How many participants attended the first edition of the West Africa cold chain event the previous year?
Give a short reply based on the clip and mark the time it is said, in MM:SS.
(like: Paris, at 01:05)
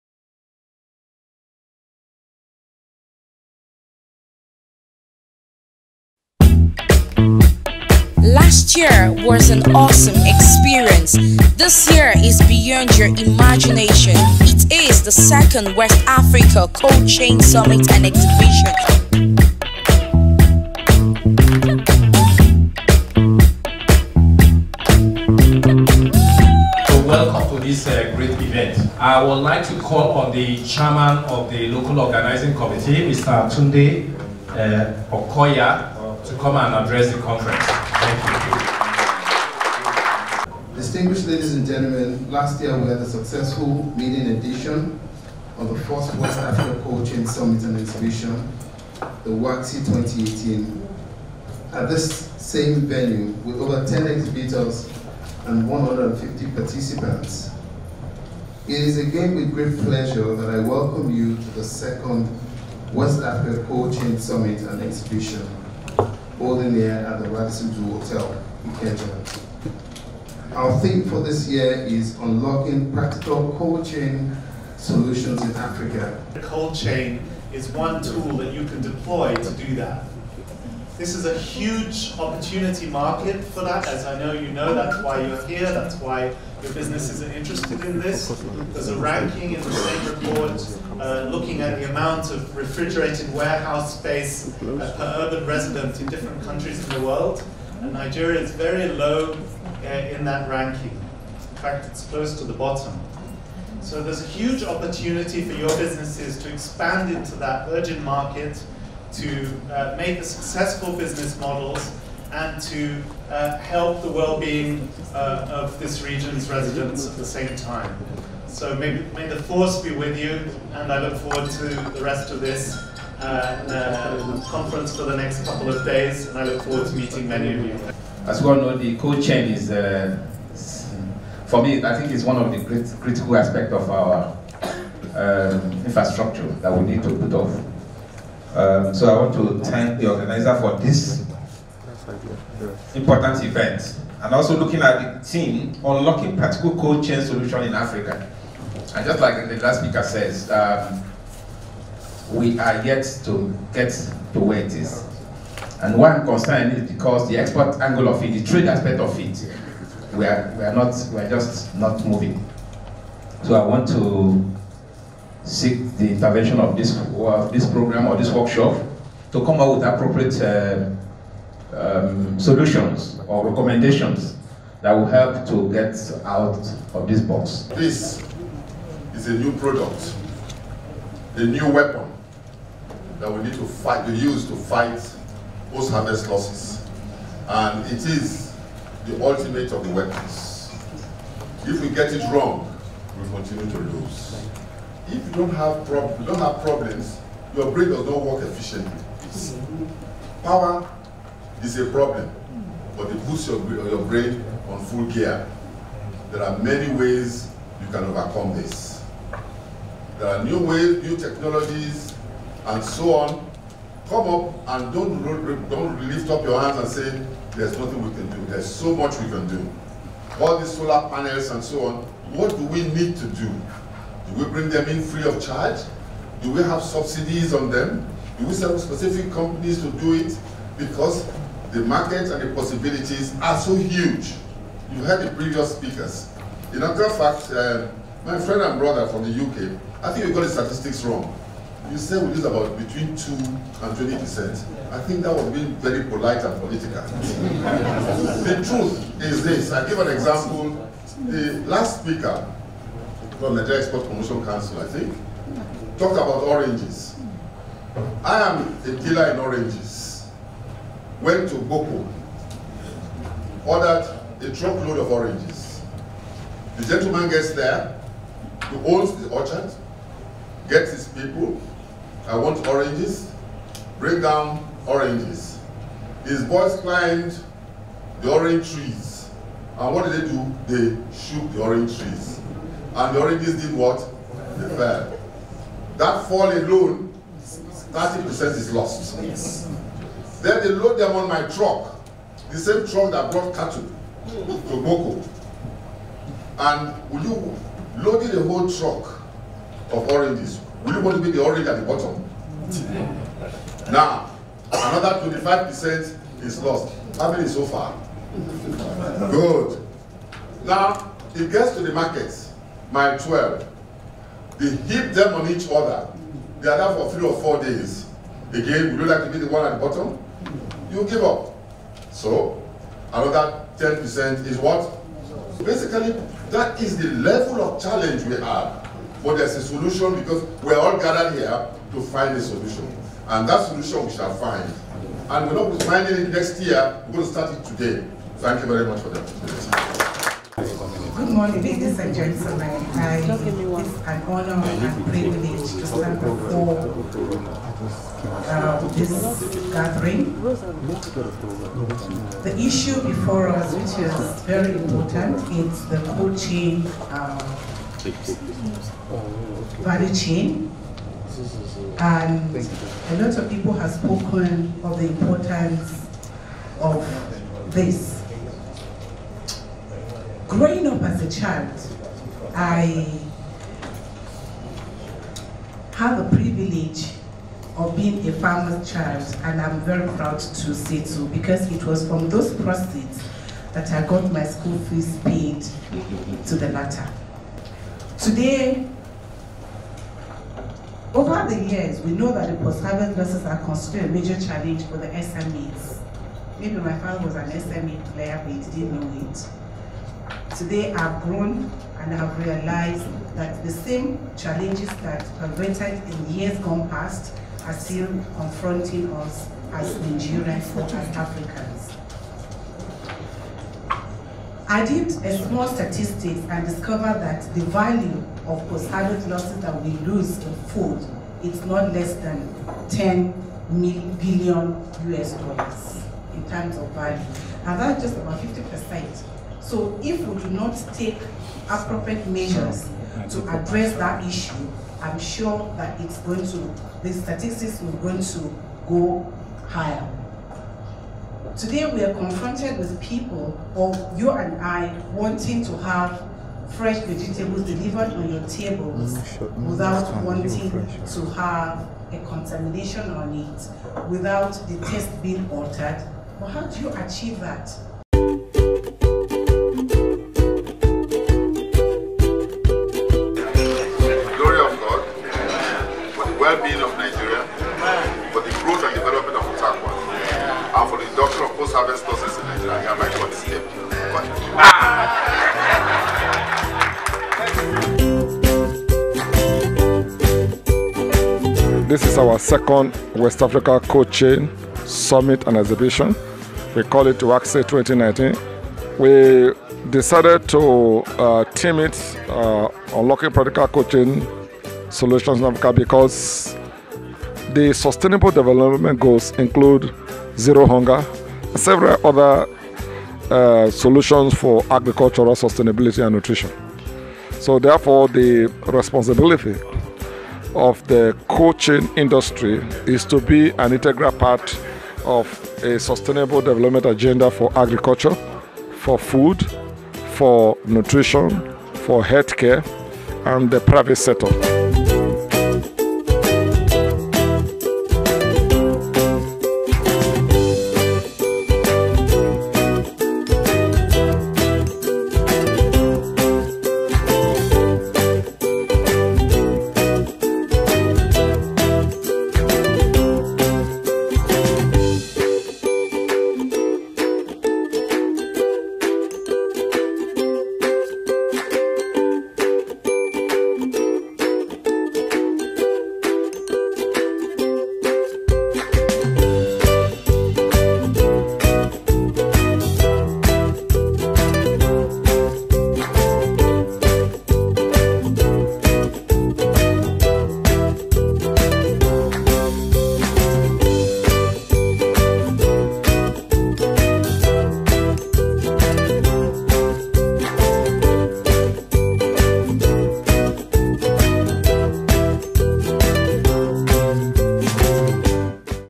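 150, at 00:55.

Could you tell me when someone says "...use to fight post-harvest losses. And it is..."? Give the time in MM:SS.
03:04.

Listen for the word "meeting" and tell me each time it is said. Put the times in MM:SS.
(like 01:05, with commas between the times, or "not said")
00:43, 02:06.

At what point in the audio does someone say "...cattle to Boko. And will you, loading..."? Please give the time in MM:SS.
04:53.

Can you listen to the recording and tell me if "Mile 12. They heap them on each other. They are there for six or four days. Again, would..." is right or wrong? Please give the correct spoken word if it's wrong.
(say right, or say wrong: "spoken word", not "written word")
wrong: "three", not "six".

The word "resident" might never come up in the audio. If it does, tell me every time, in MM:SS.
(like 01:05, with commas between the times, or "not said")
01:35, 01:56.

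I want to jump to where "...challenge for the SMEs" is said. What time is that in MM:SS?
06:34.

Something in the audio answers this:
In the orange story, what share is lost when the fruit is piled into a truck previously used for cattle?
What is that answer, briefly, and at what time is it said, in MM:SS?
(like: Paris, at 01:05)
25%, at 05:04.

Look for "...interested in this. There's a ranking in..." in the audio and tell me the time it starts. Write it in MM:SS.
01:27.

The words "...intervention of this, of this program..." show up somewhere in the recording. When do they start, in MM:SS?
02:46.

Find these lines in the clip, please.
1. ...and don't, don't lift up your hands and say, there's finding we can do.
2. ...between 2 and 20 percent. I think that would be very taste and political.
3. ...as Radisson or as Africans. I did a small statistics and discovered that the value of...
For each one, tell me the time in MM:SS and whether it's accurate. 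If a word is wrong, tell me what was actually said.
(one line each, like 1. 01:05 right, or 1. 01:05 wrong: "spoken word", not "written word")
1. 03:34 wrong: "nothing", not "finding"
2. 04:02 wrong: "polite", not "taste"
3. 06:49 wrong: "Nigerians", not "Radisson".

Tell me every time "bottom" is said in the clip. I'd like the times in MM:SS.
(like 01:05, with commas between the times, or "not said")
01:42, 05:01, 05:19.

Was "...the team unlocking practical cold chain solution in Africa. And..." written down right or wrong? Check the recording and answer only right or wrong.
right.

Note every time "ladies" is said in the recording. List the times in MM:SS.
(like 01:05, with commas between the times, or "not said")
00:41, 05:41.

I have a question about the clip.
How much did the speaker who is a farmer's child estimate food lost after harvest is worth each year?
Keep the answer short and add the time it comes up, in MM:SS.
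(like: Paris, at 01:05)
10 billion US dollars, at 07:02.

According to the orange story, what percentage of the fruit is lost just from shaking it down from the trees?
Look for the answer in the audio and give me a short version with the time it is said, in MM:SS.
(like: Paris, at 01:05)
30%, at 04:47.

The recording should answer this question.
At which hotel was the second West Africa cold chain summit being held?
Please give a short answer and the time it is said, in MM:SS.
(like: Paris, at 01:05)
Radisson Blu Hotel, at 01:07.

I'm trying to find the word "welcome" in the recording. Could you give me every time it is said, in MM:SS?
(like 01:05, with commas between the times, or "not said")
00:27, 01:00.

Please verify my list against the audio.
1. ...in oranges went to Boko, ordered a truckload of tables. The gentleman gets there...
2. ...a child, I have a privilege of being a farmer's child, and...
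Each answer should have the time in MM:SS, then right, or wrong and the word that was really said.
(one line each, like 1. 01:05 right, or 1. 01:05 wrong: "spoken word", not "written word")
1. 04:19 wrong: "oranges", not "tables"
2. 06:11 right.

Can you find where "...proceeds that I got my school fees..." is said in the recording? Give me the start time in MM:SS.
06:22.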